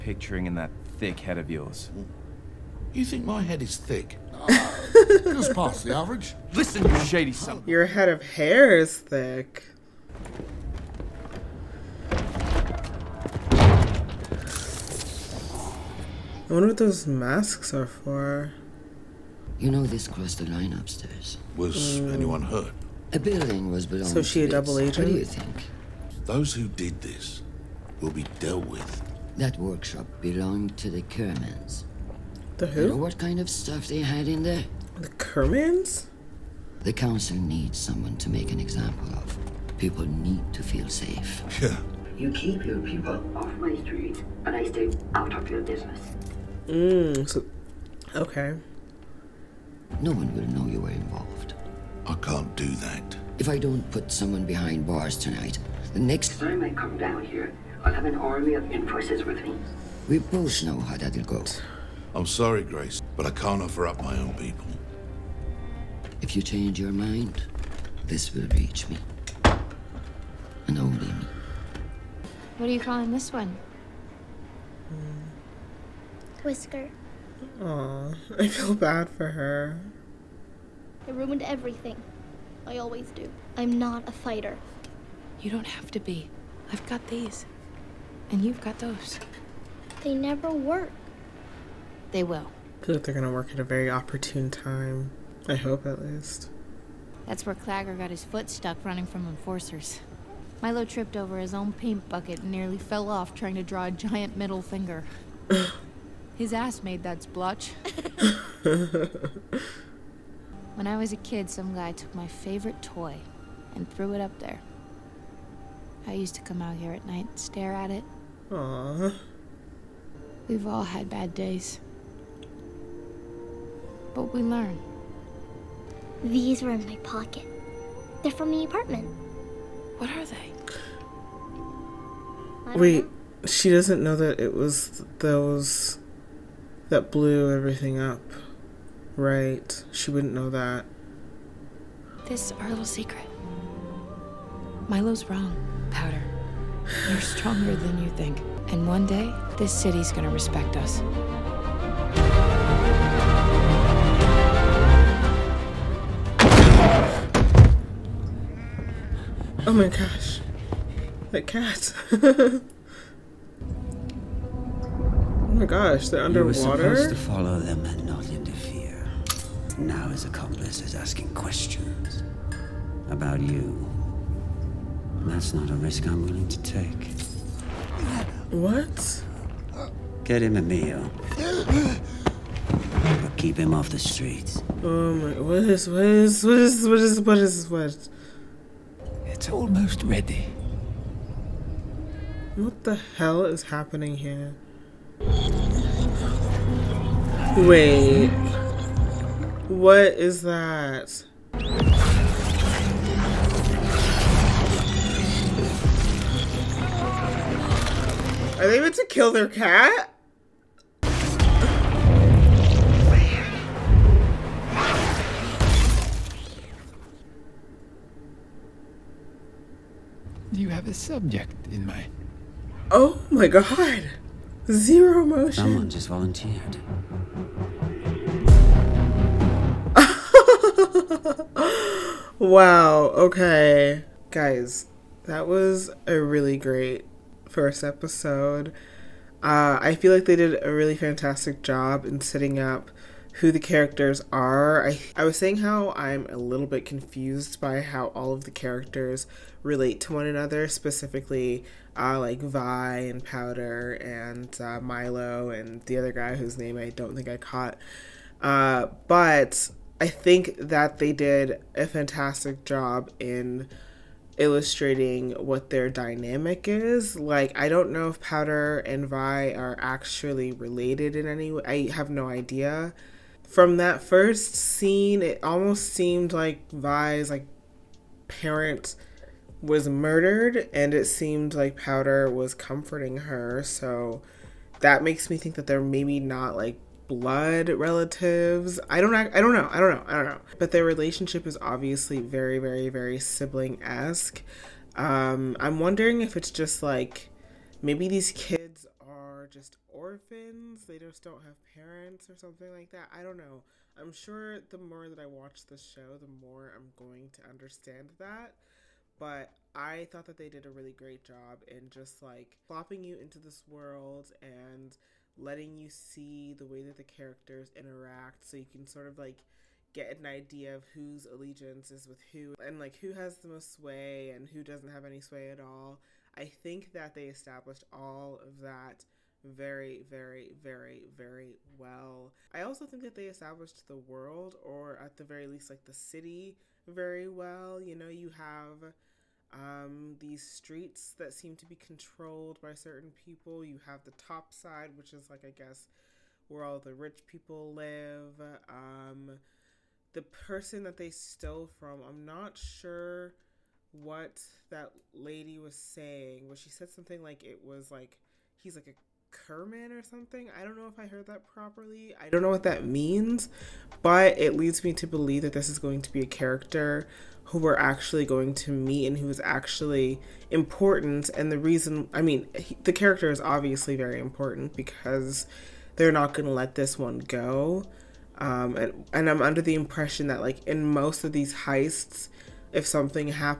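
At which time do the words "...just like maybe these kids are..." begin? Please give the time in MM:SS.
04:56.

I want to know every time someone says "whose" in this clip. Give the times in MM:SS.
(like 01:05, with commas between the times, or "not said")
04:16, 05:20.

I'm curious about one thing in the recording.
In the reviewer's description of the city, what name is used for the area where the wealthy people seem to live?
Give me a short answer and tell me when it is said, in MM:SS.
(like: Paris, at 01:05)
the top side, at 05:44.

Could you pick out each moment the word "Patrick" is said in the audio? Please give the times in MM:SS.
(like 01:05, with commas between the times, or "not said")
not said.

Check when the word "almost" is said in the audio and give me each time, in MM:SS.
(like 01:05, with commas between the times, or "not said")
03:09, 04:35.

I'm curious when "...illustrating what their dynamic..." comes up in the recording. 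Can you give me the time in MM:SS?
04:24.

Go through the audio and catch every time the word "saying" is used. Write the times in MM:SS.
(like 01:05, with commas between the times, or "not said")
04:05, 05:55.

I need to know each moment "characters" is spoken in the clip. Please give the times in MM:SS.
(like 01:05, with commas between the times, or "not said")
04:03, 04:08, 05:17, 06:06, 06:12.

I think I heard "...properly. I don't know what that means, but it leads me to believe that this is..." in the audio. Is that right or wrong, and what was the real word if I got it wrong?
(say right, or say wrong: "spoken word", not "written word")
right.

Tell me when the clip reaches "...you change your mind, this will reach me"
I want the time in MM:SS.
01:06.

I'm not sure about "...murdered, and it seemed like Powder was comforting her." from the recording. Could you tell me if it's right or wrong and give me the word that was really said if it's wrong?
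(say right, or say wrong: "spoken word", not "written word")
right.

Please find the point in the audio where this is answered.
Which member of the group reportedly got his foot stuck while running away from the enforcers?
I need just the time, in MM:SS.
01:37.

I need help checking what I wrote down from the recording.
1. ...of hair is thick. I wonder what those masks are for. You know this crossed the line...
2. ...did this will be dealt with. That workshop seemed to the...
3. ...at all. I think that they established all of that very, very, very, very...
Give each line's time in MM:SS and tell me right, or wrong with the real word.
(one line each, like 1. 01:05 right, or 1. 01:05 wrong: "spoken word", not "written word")
1. 00:08 right
2. 00:26 wrong: "belonged", not "seemed"
3. 05:25 right.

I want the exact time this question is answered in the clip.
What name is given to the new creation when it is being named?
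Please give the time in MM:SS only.
01:16.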